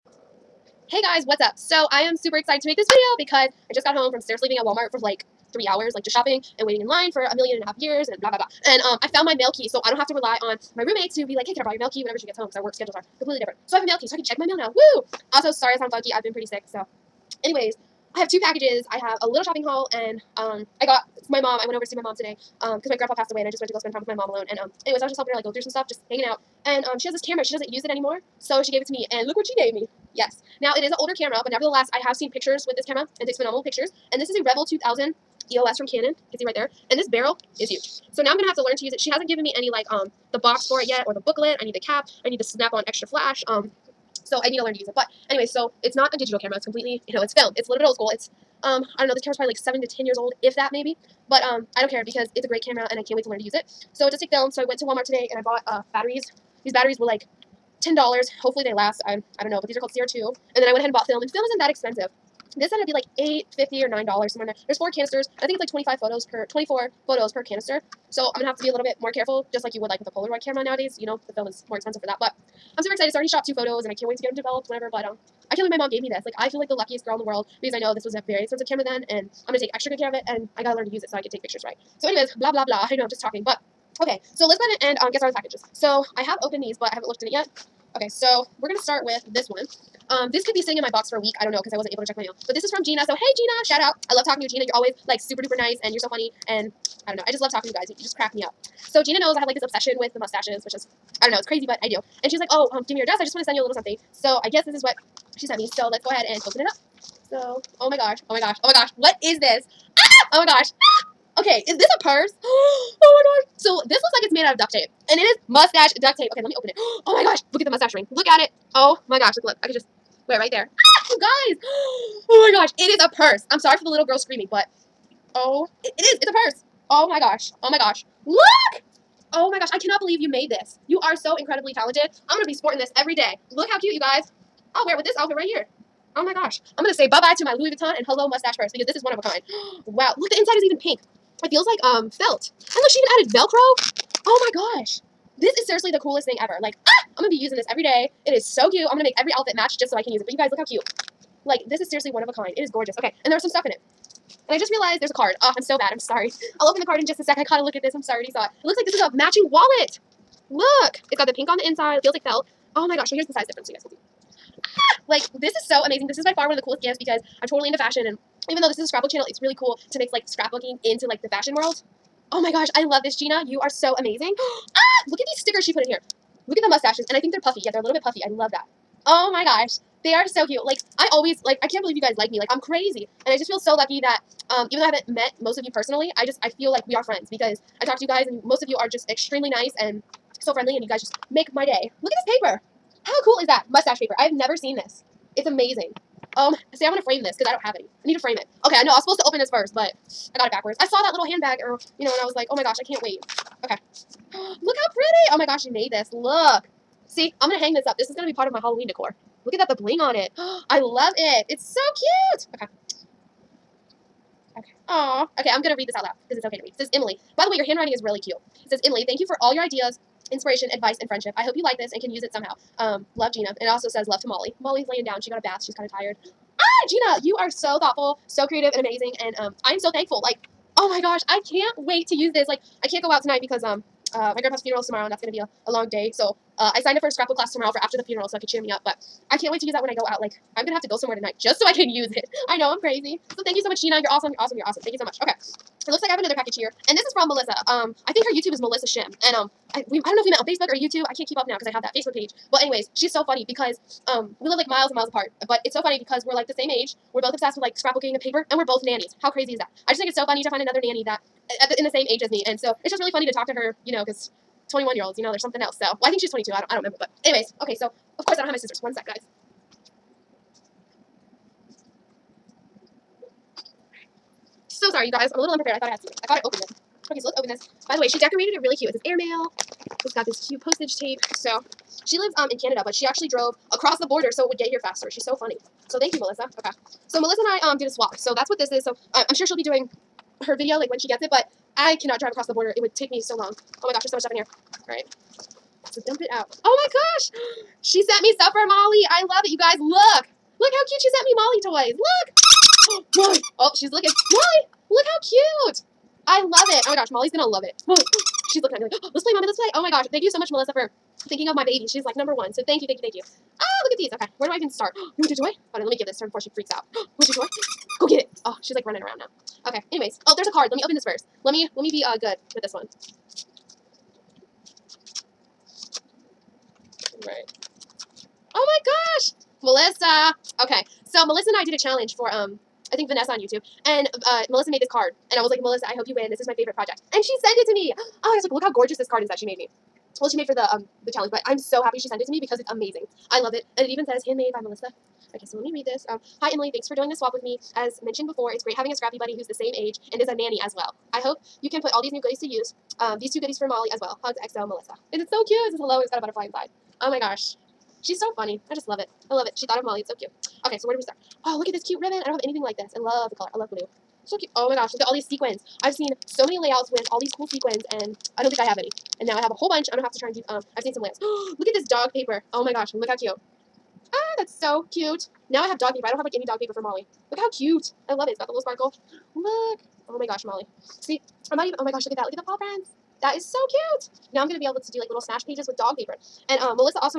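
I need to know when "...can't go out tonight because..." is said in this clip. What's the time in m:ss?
3:52.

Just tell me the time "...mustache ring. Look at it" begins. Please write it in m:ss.
1:57.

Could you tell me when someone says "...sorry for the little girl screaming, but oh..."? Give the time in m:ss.
2:03.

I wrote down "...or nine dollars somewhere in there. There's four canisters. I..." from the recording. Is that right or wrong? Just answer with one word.
right.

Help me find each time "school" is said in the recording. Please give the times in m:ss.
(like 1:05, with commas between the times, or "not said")
0:47.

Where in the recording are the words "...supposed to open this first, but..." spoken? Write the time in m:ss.
3:19.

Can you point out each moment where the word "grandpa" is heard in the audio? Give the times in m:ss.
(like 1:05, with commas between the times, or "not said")
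0:22, 3:54.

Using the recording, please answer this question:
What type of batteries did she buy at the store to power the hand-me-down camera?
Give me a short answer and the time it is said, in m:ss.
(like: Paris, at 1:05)
CR2, at 0:59.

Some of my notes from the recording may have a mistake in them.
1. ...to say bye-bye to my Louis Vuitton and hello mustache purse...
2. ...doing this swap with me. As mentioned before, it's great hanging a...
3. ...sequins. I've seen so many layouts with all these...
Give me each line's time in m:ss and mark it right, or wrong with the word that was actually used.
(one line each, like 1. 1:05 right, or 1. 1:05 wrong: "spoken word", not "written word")
1. 2:16 right
2. 5:46 wrong: "having", not "hanging"
3. 6:05 right.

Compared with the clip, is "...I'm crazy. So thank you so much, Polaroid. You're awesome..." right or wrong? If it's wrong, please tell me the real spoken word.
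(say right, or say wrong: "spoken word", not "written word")
wrong: "Gina", not "Polaroid".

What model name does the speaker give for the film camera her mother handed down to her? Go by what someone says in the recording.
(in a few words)
Rebel 2000 EOS.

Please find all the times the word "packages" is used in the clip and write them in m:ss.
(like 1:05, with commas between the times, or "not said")
0:18, 1:25, 4:06.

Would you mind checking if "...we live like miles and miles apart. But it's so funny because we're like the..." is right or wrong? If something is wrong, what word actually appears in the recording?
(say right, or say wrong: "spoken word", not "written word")
right.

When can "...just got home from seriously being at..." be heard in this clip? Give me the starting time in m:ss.
0:03.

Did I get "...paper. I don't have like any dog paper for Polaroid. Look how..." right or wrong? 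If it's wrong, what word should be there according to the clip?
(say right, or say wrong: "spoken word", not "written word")
wrong: "Molly", not "Polaroid".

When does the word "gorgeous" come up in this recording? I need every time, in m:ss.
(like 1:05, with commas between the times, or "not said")
2:32, 5:38.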